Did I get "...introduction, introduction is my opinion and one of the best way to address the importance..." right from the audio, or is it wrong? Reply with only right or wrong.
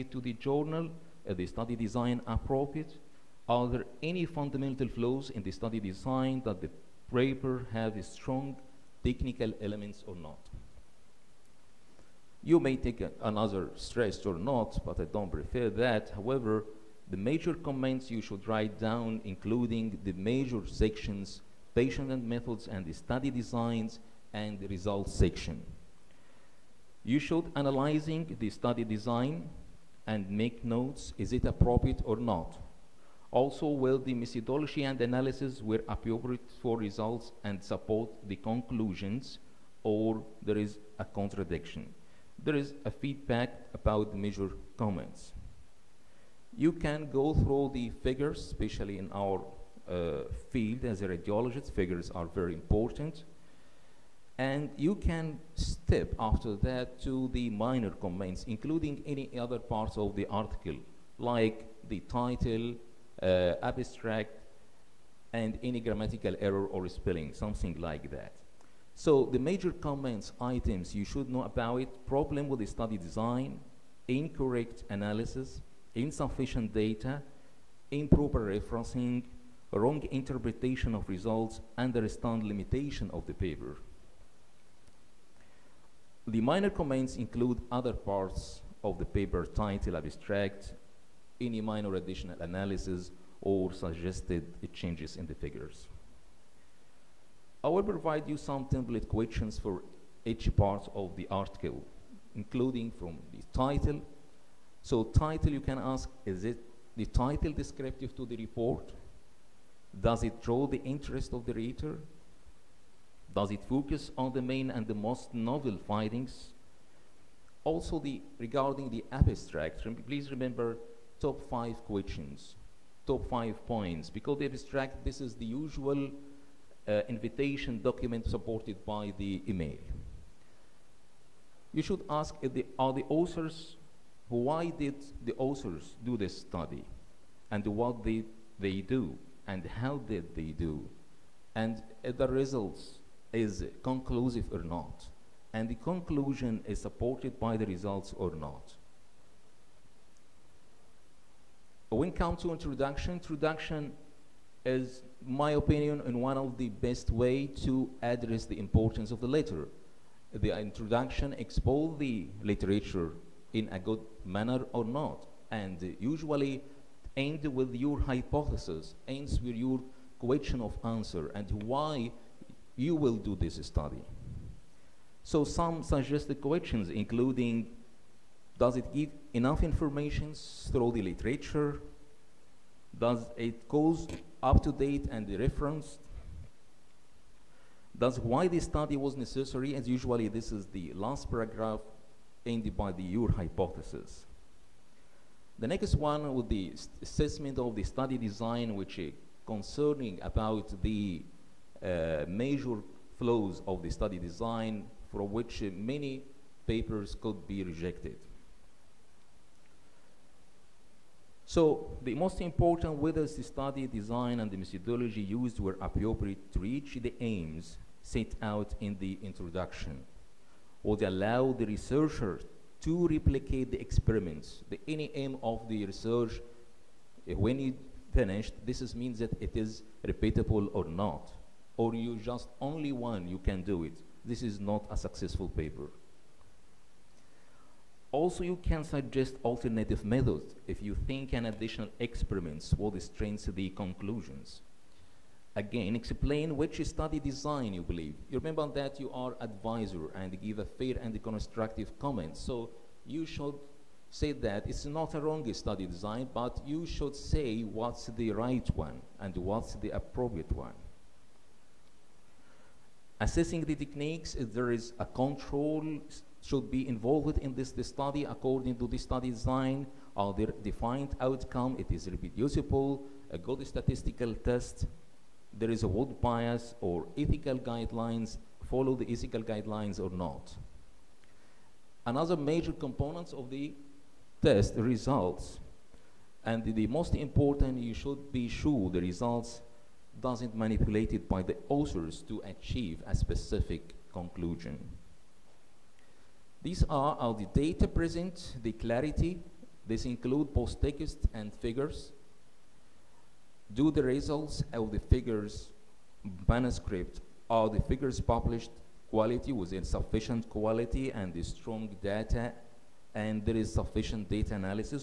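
right.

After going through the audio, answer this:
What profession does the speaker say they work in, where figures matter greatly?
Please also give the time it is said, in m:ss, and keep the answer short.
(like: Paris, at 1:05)
Radiologist, at 0:51.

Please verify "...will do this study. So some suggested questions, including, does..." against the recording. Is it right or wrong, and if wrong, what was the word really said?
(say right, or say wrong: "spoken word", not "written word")
right.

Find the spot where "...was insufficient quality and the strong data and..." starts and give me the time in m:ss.
5:09.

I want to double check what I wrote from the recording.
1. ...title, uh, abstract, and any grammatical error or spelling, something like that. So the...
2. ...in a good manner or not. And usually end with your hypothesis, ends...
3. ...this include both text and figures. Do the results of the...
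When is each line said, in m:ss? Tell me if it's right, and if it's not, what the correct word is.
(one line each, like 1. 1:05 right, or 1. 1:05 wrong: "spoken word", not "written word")
1. 1:02 right
2. 2:43 right
3. 4:59 right.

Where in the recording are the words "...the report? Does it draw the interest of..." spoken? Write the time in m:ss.
1:48.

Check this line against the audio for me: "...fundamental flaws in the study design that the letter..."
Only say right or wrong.
wrong.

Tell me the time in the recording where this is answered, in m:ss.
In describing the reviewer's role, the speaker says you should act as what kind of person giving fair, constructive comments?
4:09.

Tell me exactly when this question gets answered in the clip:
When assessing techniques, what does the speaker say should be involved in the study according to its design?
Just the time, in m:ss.
4:24.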